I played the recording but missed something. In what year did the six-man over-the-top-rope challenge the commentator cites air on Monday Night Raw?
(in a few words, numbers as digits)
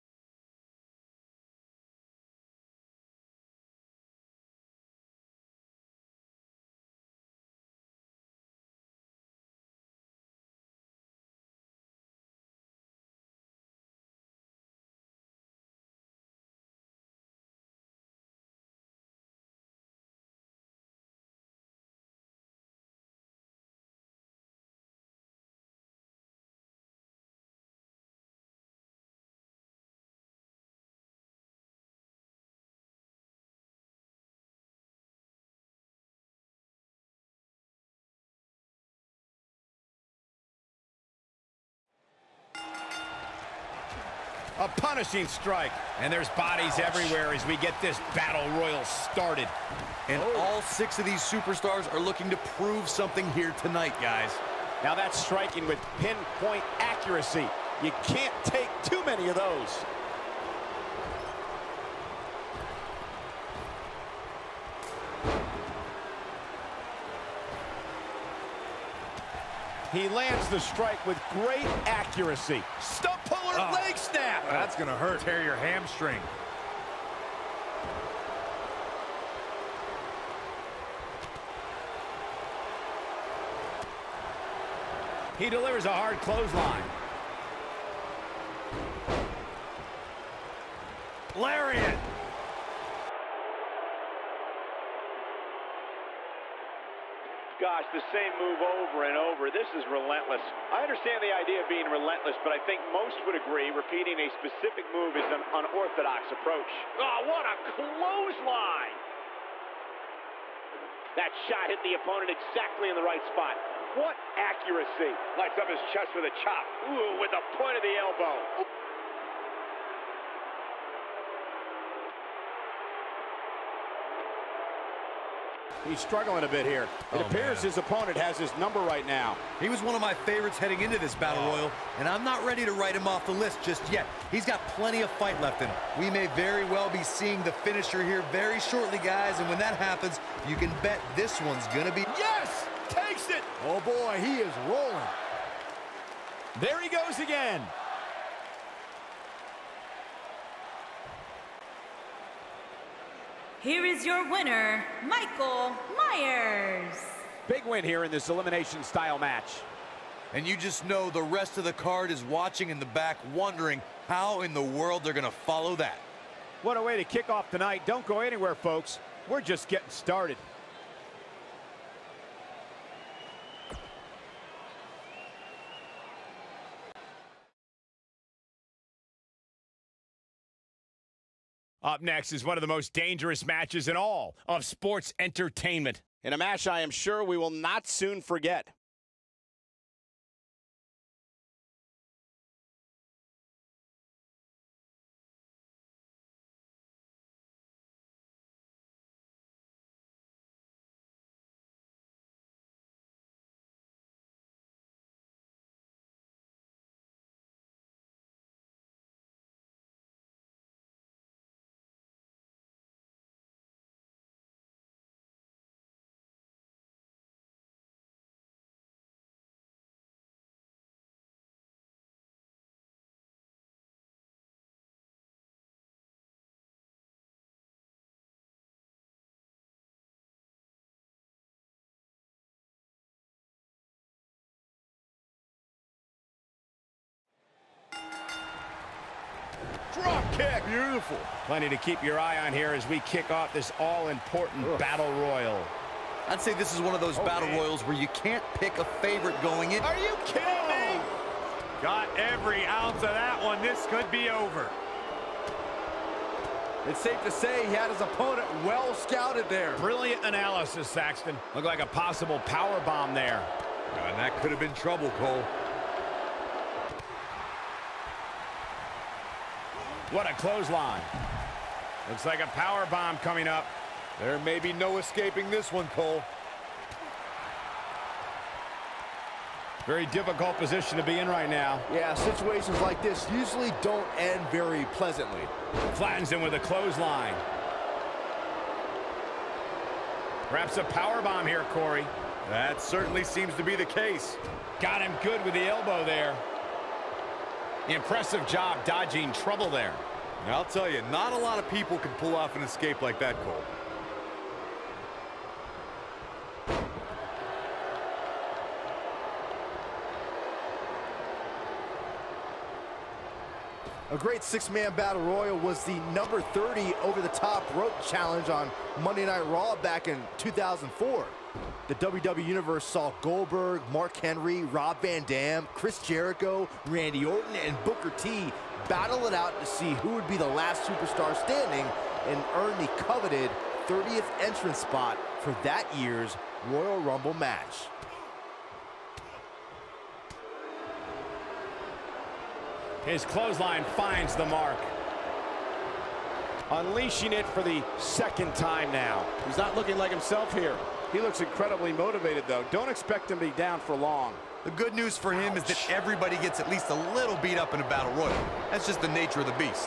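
2004.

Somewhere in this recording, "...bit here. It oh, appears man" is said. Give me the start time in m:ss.
2:06.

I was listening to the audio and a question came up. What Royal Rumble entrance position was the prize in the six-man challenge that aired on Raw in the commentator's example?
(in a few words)
30th.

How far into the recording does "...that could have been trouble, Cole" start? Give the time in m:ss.
4:24.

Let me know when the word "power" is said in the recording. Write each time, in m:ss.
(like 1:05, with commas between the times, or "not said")
4:22, 4:32, 4:50.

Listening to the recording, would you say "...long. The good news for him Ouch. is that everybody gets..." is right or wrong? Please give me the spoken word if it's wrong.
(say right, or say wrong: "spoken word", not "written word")
right.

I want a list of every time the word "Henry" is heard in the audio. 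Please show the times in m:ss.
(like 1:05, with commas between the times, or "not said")
5:24.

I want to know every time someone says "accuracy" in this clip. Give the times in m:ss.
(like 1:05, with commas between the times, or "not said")
0:56, 1:11, 1:54.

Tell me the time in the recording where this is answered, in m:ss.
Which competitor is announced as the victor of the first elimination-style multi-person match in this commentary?
2:35.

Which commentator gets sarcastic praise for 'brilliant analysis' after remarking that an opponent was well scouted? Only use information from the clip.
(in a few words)
Saxton.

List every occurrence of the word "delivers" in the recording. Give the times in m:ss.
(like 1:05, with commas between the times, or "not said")
1:25.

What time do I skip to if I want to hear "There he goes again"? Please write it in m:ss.
2:26.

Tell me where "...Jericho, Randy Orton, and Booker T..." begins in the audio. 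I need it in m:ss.
5:26.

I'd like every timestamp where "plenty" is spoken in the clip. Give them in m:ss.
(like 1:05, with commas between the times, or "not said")
2:14, 4:01.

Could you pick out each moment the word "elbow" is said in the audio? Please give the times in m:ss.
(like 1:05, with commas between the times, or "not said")
1:57, 4:55.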